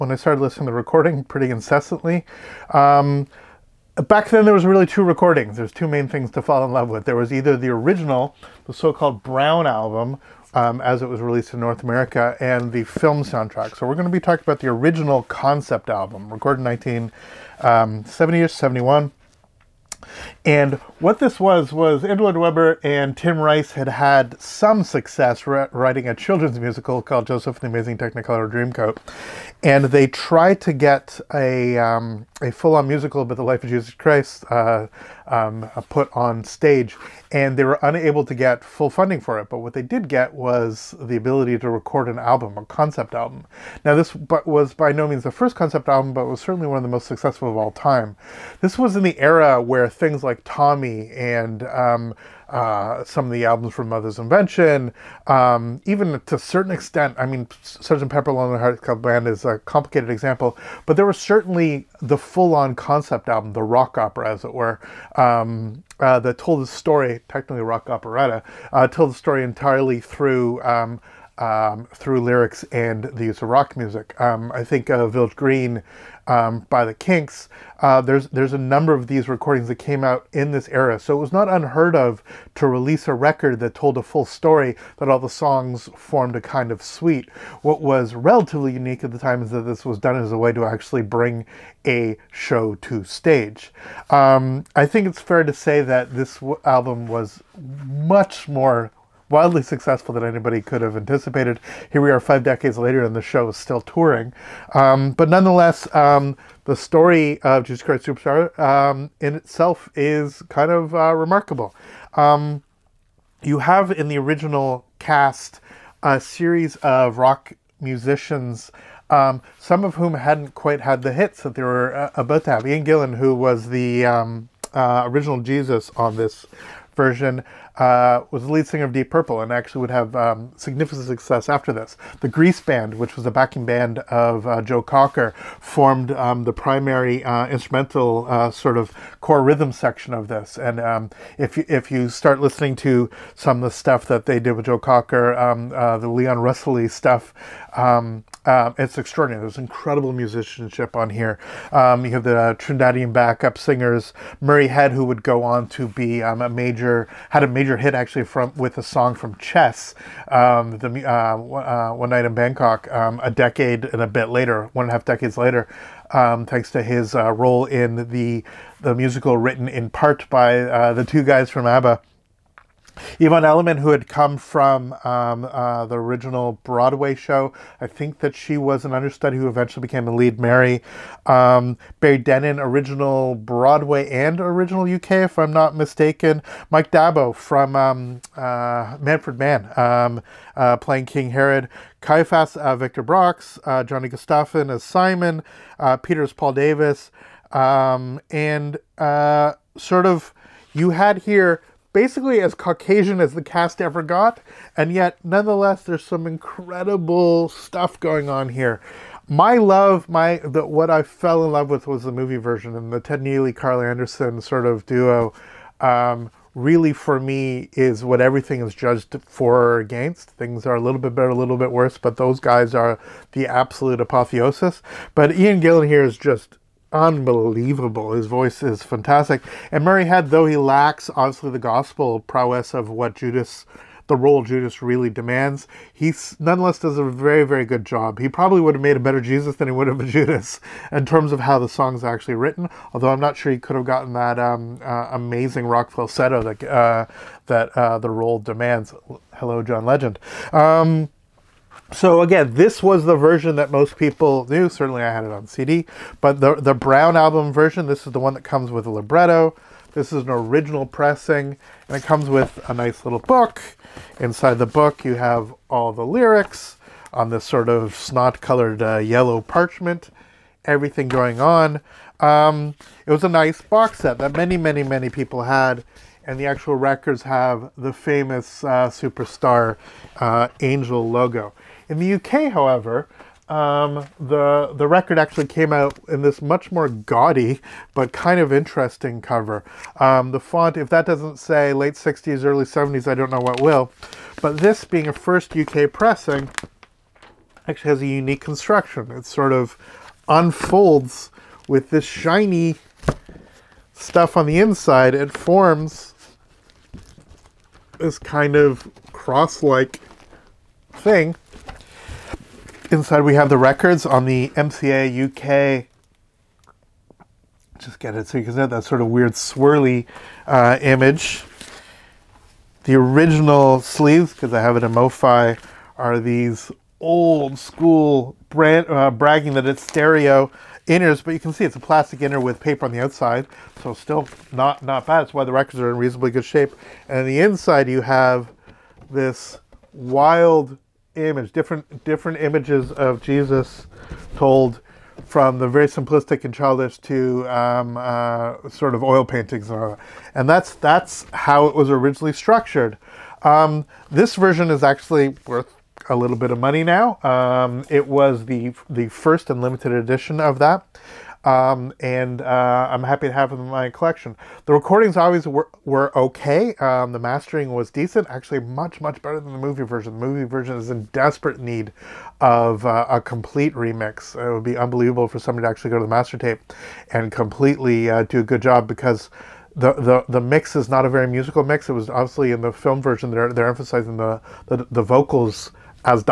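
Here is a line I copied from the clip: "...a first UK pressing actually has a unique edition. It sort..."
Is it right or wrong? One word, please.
wrong.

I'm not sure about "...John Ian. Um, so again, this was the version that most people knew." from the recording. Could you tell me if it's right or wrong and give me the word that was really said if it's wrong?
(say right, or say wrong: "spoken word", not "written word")
wrong: "Legend", not "Ian".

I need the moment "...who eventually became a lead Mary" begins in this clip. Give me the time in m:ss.
2:59.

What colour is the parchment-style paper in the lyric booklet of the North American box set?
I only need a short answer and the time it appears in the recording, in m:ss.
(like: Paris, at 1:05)
Yellow, at 4:28.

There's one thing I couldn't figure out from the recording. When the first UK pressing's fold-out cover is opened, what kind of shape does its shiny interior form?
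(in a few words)
Cross-like.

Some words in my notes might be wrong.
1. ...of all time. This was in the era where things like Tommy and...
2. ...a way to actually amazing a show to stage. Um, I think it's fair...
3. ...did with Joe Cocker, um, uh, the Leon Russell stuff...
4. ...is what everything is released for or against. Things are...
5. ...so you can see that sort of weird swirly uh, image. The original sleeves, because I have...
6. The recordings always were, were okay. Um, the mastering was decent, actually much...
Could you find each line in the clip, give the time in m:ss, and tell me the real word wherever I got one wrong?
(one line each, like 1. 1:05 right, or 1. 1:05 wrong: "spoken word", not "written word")
1. 0:47 right
2. 1:30 wrong: "bring", not "amazing"
3. 2:24 right
4. 3:37 wrong: "judged", not "released"
5. 5:18 right
6. 6:04 right.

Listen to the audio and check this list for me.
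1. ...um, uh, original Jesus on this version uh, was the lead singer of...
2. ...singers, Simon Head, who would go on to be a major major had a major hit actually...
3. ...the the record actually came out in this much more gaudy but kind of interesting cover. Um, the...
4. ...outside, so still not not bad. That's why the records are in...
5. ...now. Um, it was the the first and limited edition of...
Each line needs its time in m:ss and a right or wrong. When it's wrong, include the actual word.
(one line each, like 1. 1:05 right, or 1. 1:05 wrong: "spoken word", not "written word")
1. 2:04 right
2. 2:33 wrong: "Murray", not "Simon"
3. 4:44 right
4. 5:32 right
5. 5:56 right.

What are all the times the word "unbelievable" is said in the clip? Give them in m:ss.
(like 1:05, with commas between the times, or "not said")
3:46, 6:14.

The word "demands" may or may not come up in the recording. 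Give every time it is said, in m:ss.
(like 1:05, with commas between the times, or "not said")
3:55, 4:08.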